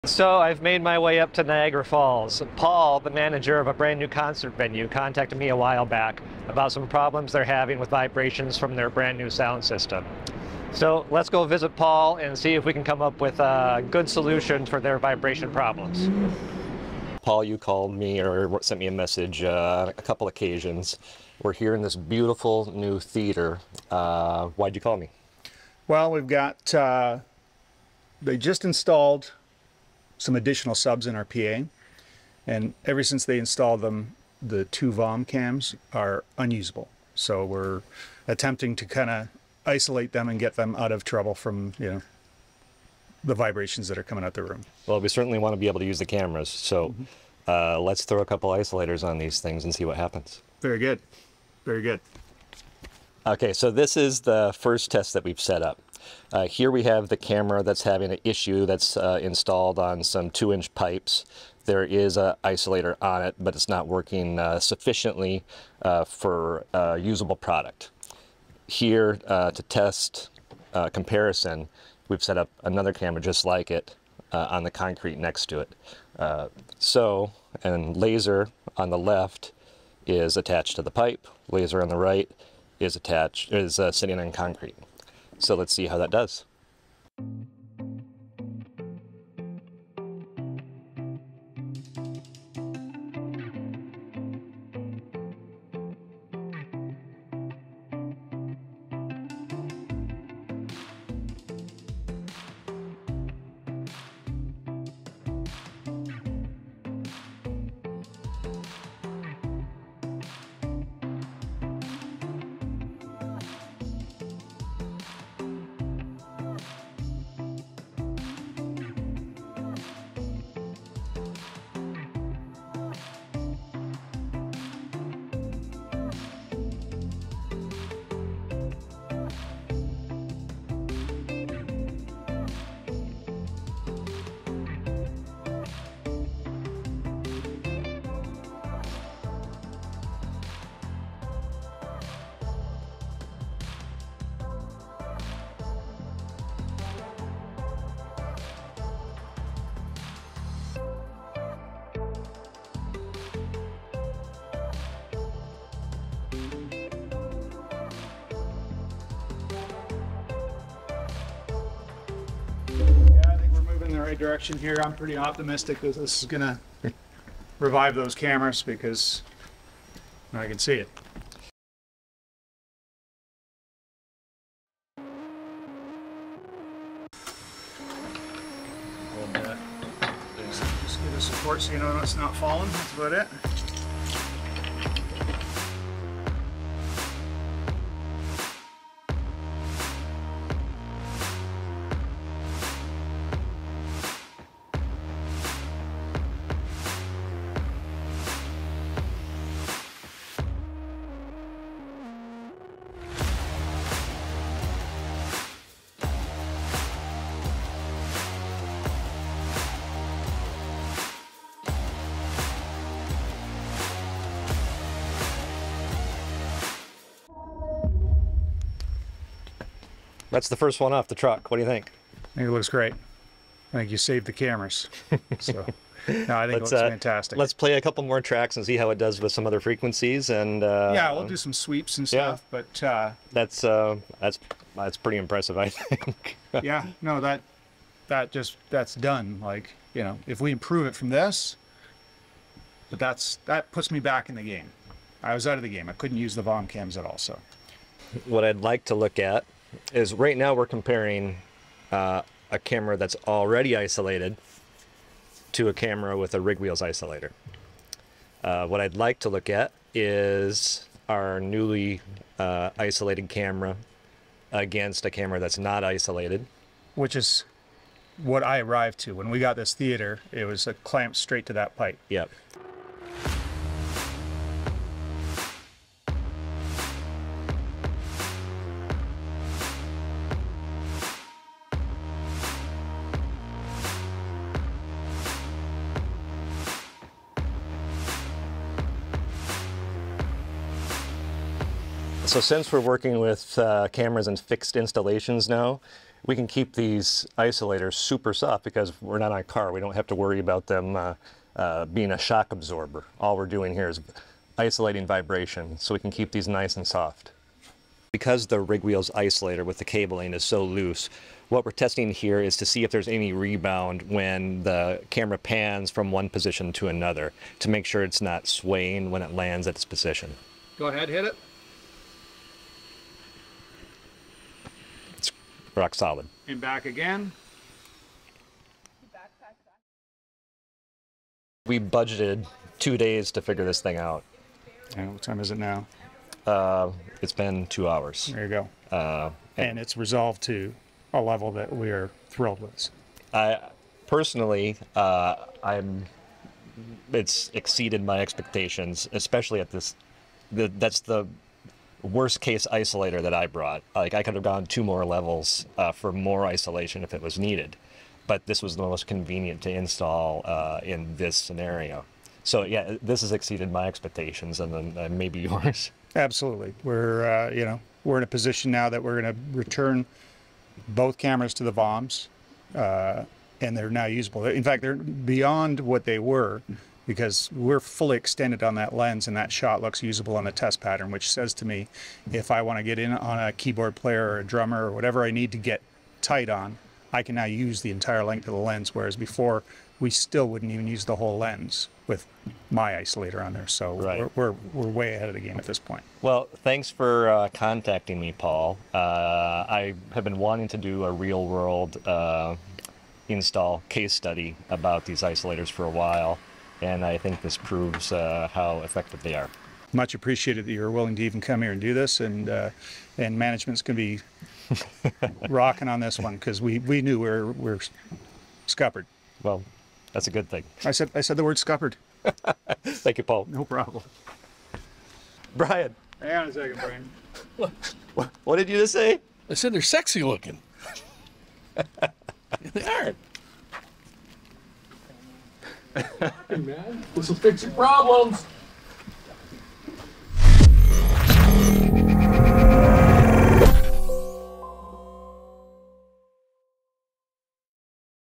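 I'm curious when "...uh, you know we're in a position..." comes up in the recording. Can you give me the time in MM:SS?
06:07.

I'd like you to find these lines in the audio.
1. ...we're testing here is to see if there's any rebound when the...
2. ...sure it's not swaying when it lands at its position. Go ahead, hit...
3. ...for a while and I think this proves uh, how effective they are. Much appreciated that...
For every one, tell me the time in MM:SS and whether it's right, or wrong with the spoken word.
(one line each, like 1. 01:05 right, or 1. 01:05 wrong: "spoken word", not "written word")
1. 05:11 right
2. 05:17 right
3. 06:45 right.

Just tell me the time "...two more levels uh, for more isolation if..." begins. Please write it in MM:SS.
05:54.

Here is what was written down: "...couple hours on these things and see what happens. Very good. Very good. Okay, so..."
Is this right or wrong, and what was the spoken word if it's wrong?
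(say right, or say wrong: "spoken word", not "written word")
wrong: "isolators", not "hours".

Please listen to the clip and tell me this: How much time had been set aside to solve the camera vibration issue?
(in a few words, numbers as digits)
two days.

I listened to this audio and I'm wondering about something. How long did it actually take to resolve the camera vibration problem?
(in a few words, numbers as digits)
two hours.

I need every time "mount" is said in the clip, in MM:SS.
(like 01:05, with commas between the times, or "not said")
not said.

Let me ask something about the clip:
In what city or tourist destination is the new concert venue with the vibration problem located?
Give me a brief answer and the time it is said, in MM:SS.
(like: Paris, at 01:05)
Niagara Falls, at 00:01.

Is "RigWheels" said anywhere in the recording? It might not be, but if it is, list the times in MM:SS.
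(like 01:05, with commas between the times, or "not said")
04:16, 05:08.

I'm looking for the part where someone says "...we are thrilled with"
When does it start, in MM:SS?
05:41.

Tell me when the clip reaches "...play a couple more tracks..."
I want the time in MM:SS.
03:47.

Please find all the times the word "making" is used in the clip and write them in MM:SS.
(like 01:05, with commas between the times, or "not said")
not said.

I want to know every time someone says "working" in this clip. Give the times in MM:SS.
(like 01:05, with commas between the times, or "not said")
01:03, 04:52.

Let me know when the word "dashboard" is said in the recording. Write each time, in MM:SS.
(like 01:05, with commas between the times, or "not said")
not said.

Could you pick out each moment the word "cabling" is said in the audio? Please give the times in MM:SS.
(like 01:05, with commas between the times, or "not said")
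05:09.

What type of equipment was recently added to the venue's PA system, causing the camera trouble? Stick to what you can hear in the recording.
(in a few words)
subs.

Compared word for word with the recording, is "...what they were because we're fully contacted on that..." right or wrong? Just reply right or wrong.
wrong.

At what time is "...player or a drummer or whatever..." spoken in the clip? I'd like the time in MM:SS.
06:23.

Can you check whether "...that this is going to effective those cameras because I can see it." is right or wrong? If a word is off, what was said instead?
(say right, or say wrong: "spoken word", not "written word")
wrong: "revive", not "effective".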